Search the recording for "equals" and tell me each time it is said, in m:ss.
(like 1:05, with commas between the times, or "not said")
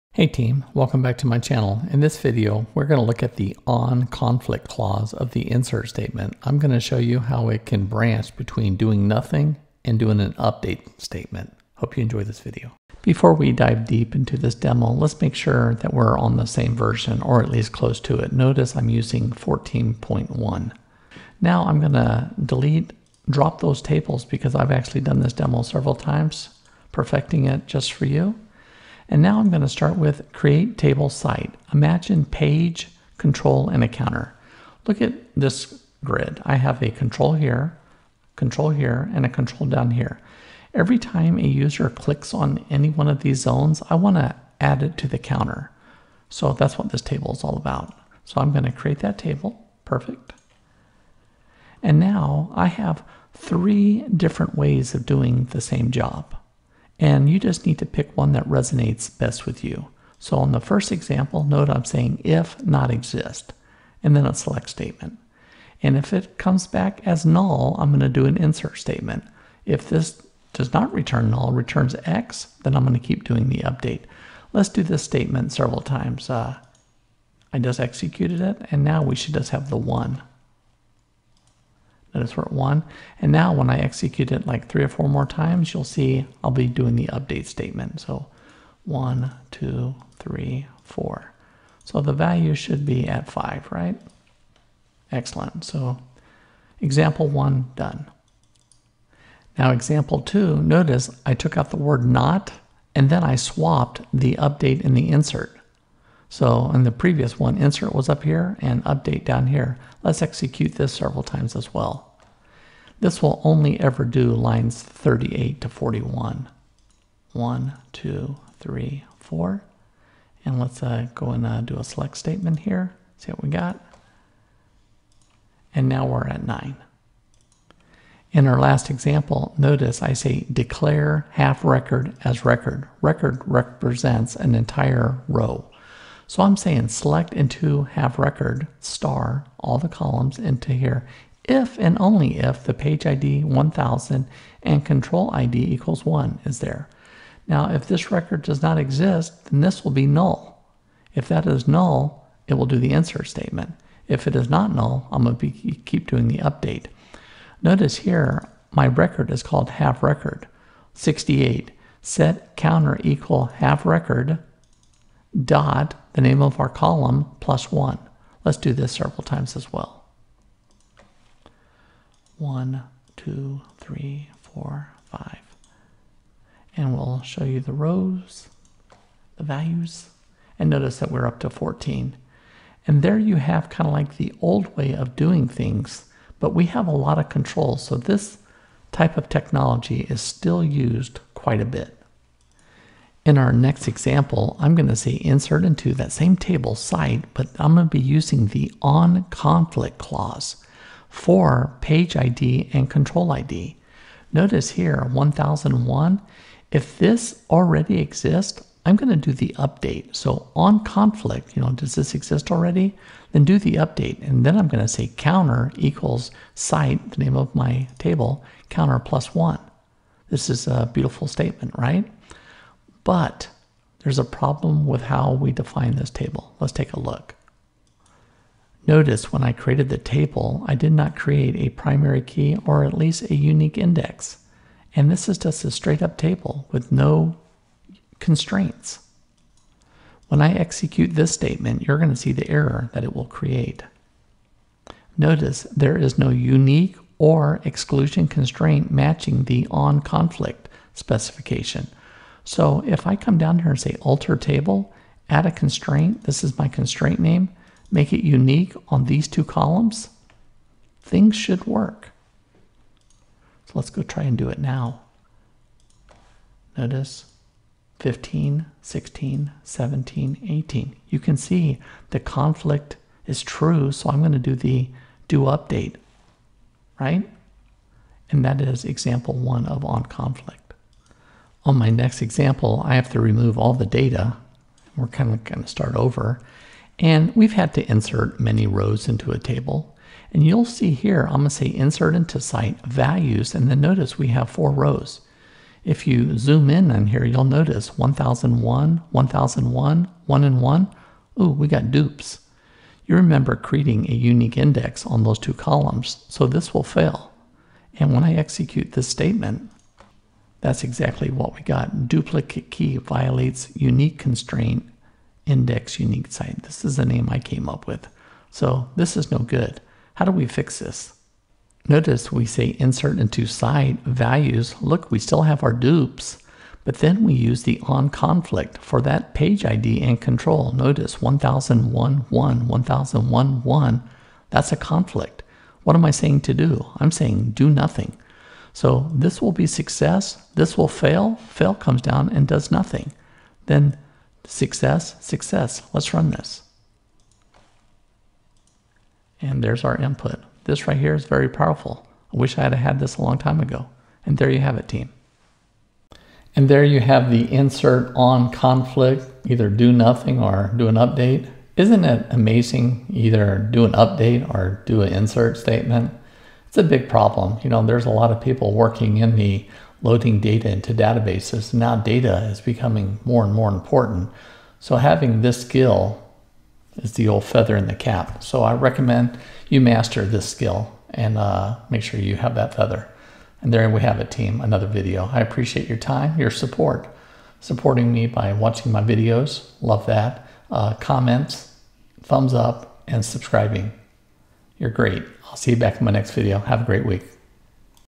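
2:25, 2:43, 3:35.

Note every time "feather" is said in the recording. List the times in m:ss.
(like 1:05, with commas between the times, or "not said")
6:17, 6:22.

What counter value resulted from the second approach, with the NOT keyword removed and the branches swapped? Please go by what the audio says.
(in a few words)
9.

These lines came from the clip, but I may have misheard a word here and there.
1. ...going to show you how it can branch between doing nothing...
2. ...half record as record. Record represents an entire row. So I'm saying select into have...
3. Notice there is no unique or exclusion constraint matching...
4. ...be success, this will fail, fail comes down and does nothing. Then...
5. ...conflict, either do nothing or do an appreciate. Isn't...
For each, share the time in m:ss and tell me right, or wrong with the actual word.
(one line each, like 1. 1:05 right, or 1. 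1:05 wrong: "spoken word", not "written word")
1. 0:06 right
2. 2:11 right
3. 4:05 right
4. 5:39 right
5. 5:58 wrong: "update", not "appreciate".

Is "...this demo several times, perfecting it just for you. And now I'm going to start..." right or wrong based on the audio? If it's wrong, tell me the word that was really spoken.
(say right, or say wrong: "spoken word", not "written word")
right.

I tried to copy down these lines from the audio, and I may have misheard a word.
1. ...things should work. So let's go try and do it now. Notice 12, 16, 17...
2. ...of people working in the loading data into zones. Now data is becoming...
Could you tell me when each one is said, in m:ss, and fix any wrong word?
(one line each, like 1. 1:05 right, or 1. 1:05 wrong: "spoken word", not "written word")
1. 4:21 wrong: "15", not "12"
2. 6:08 wrong: "databases", not "zones".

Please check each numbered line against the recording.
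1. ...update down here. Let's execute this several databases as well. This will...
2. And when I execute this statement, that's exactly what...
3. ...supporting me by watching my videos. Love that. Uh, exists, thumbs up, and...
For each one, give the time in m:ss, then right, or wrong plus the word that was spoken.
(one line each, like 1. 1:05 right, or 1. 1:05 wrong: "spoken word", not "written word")
1. 1:48 wrong: "times", not "databases"
2. 5:07 right
3. 6:27 wrong: "comments", not "exists".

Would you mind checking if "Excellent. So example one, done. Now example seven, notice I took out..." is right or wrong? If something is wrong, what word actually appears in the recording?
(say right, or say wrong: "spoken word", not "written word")
wrong: "two", not "seven".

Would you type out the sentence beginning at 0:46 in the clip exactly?
So that's what this table is all about.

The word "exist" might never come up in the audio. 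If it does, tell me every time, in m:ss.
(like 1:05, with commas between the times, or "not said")
1:02, 2:28, 3:27, 3:32.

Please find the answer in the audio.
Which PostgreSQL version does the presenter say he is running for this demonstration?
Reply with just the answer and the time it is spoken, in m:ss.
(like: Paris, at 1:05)
14.1, at 0:19.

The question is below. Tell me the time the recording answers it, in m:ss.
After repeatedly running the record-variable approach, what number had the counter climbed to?
3:01.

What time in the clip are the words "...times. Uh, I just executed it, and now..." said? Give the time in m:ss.
1:15.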